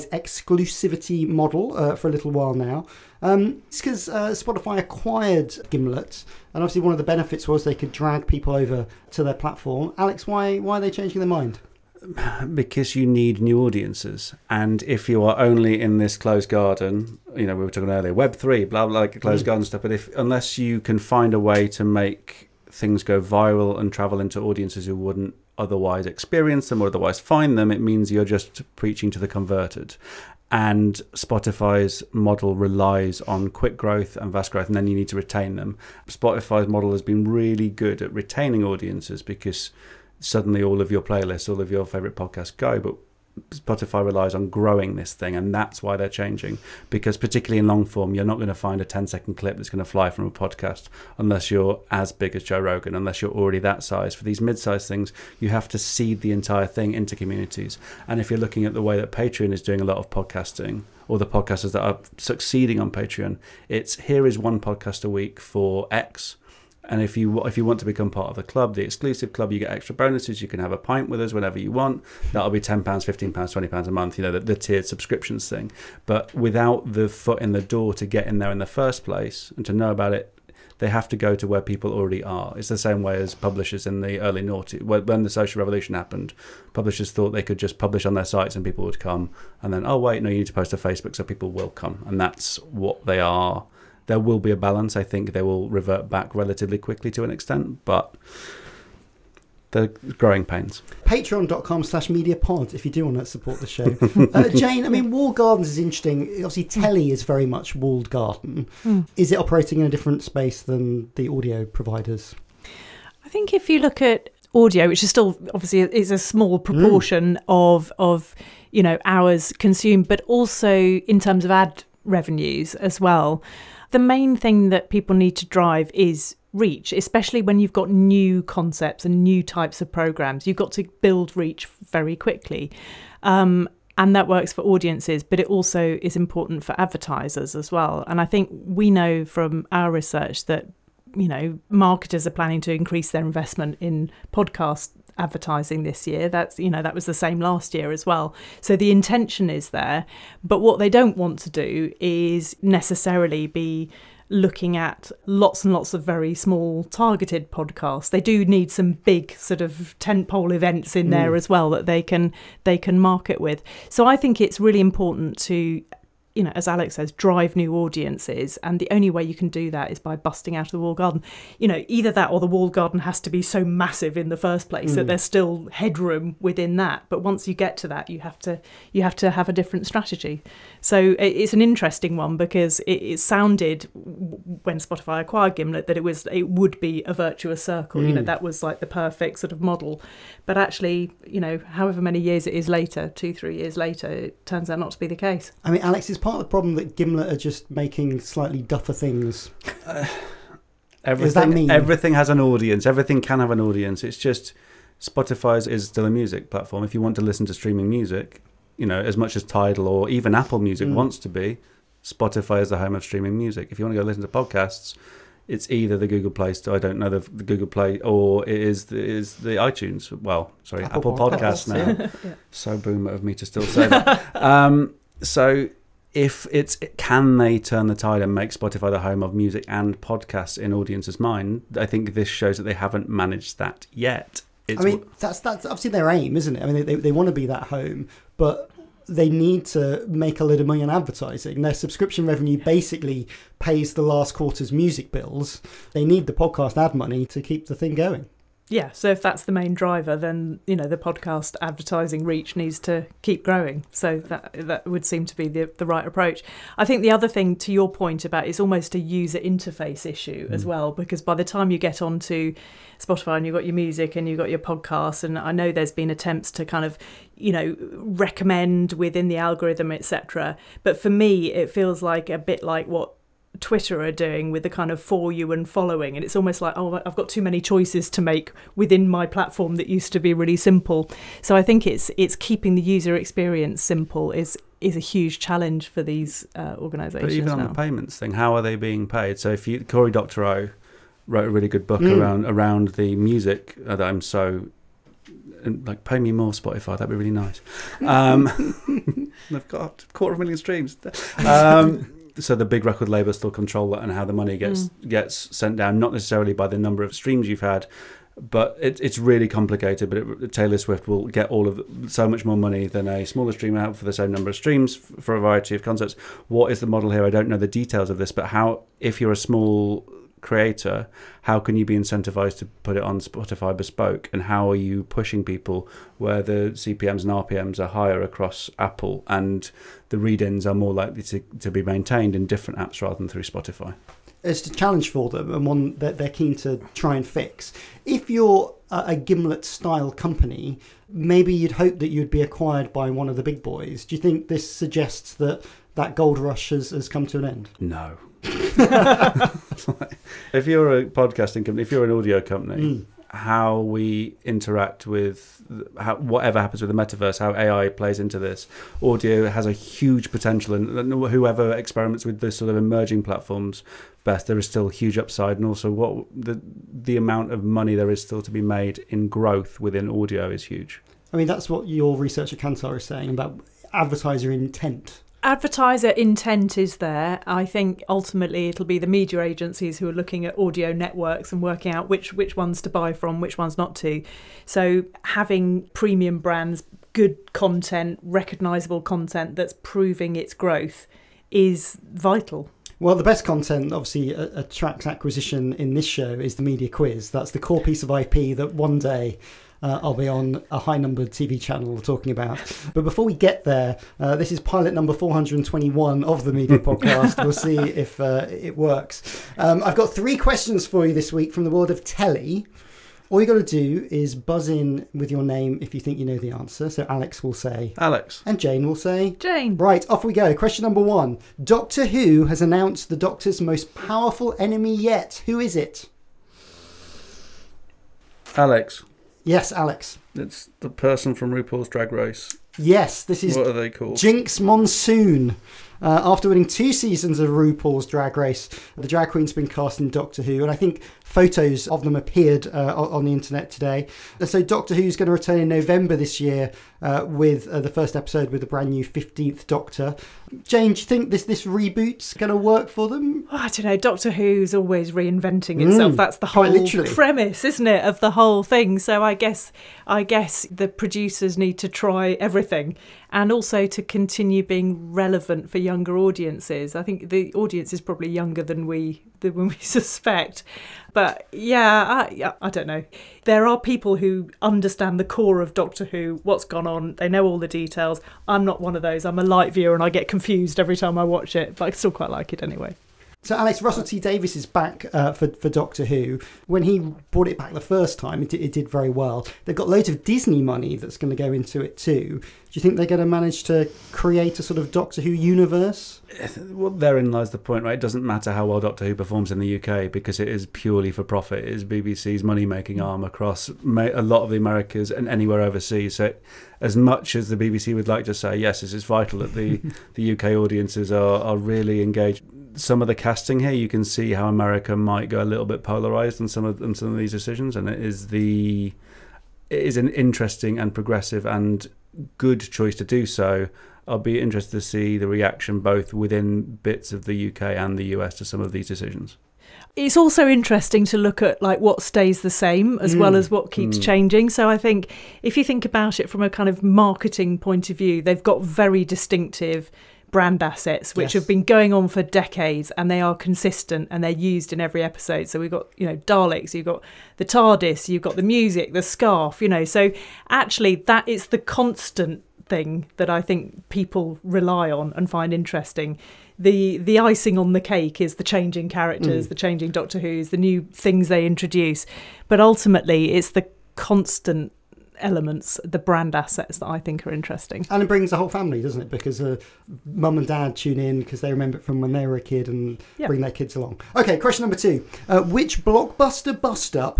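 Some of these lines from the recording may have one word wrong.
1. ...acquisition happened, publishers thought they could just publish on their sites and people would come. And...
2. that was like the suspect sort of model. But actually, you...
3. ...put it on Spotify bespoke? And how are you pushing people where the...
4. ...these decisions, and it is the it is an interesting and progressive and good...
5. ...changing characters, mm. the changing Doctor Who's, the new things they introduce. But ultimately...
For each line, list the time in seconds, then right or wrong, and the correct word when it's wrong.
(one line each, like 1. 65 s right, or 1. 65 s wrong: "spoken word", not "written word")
1. 85 s wrong: "revolution", not "acquisition"
2. 188 s wrong: "perfect", not "suspect"
3. 322 s right
4. 517 s right
5. 558 s right.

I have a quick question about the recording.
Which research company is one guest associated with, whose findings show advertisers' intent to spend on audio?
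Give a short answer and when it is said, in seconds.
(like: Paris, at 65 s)
Kantar, at 372 s.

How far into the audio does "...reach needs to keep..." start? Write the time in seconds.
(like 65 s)
252 s.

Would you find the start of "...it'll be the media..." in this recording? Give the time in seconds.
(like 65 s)
378 s.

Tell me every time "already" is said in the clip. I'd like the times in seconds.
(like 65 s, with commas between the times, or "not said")
53 s, 81 s.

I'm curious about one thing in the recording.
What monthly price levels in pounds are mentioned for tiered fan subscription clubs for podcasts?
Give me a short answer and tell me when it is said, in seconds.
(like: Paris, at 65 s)
10, 15 and 20 pounds, at 72 s.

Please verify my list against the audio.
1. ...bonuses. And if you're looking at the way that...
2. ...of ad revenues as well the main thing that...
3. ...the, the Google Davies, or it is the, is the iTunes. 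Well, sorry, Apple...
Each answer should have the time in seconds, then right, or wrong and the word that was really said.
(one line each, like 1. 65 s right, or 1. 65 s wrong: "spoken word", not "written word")
1. 57 s wrong: "communities", not "bonuses"
2. 121 s right
3. 217 s wrong: "Play", not "Davies".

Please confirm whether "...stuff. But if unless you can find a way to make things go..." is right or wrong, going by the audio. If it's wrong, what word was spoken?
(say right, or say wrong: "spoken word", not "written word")
right.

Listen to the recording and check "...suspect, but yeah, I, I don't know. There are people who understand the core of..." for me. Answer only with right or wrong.
right.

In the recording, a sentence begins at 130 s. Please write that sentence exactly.
You've got to build reach very quickly.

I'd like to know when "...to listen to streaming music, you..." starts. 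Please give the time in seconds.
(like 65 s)
207 s.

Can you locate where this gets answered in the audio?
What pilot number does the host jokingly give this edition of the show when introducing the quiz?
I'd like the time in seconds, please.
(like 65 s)
404 s.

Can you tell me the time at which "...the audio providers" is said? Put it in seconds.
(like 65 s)
111 s.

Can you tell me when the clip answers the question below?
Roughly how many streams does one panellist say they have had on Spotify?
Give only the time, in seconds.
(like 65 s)
300 s.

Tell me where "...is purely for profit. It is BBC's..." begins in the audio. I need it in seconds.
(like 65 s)
500 s.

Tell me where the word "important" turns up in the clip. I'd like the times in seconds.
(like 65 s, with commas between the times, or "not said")
136 s, 164 s.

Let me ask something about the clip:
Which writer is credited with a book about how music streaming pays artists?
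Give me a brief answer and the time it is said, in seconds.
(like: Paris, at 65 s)
Corey Doctorow, at 289 s.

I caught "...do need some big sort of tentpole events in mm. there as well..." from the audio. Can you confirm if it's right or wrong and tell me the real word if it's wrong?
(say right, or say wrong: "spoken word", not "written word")
right.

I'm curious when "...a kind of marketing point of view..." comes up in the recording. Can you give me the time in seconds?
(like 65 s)
536 s.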